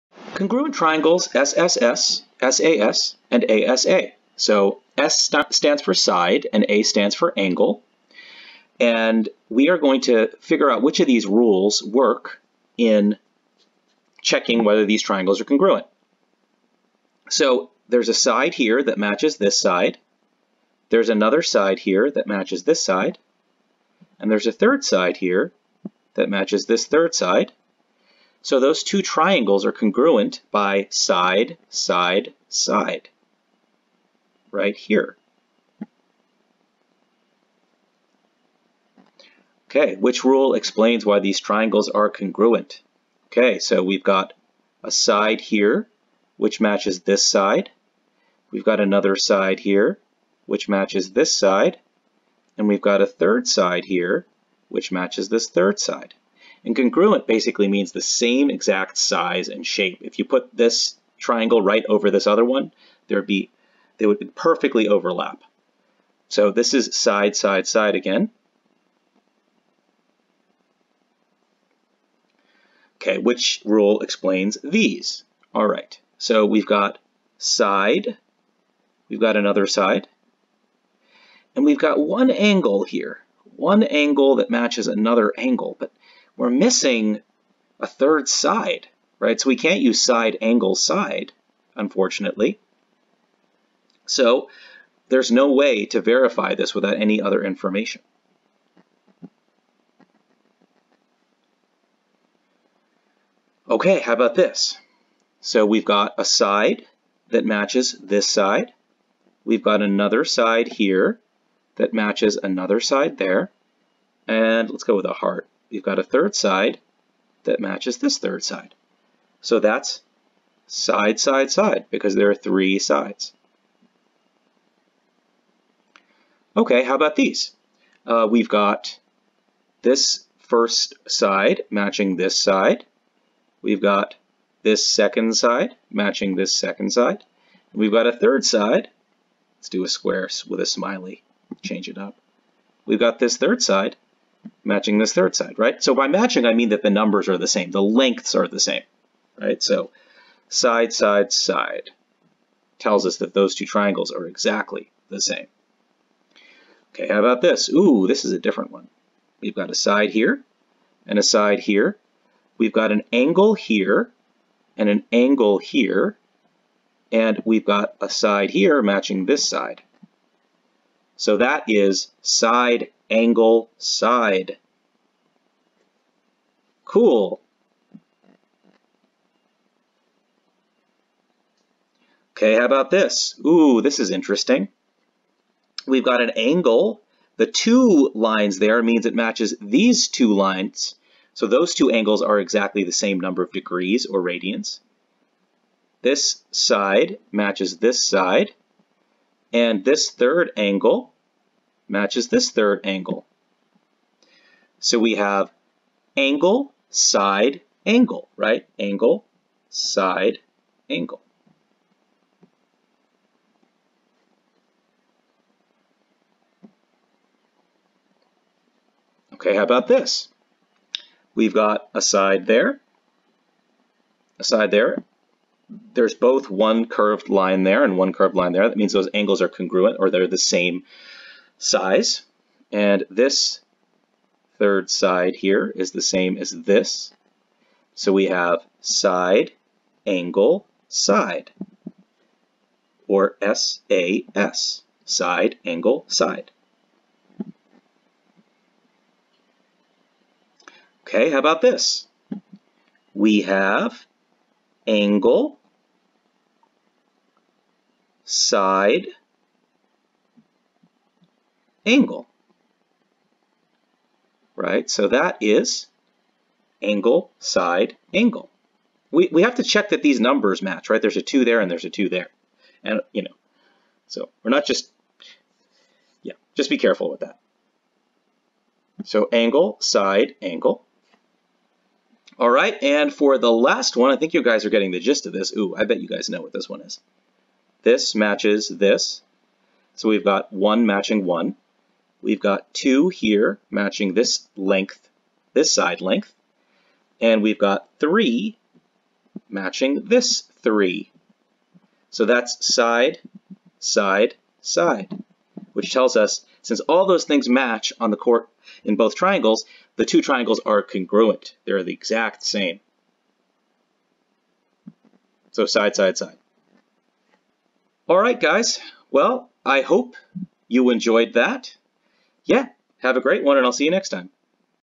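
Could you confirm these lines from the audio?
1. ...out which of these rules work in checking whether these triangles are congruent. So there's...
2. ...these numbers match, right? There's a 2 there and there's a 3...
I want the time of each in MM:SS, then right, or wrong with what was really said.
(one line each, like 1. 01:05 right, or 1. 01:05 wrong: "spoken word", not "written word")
1. 00:10 right
2. 04:30 wrong: "2", not "3".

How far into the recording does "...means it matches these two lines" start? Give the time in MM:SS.
03:08.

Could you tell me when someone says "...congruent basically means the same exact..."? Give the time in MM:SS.
00:56.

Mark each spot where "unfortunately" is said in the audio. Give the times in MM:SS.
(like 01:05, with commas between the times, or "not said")
01:31.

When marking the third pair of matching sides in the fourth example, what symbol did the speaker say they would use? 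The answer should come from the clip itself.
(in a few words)
a heart.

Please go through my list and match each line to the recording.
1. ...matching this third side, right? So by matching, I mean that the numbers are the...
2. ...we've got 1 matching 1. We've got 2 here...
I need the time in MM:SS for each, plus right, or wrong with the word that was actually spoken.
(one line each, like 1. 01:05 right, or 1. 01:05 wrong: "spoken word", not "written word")
1. 02:24 right
2. 04:50 right.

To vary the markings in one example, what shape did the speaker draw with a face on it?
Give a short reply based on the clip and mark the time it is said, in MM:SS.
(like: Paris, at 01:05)
a square, at 02:19.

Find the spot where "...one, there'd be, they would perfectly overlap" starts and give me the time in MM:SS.
01:02.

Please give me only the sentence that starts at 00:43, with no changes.
Okay, so we've got a side here, which matches this side.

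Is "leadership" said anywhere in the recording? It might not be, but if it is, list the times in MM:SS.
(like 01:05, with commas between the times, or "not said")
not said.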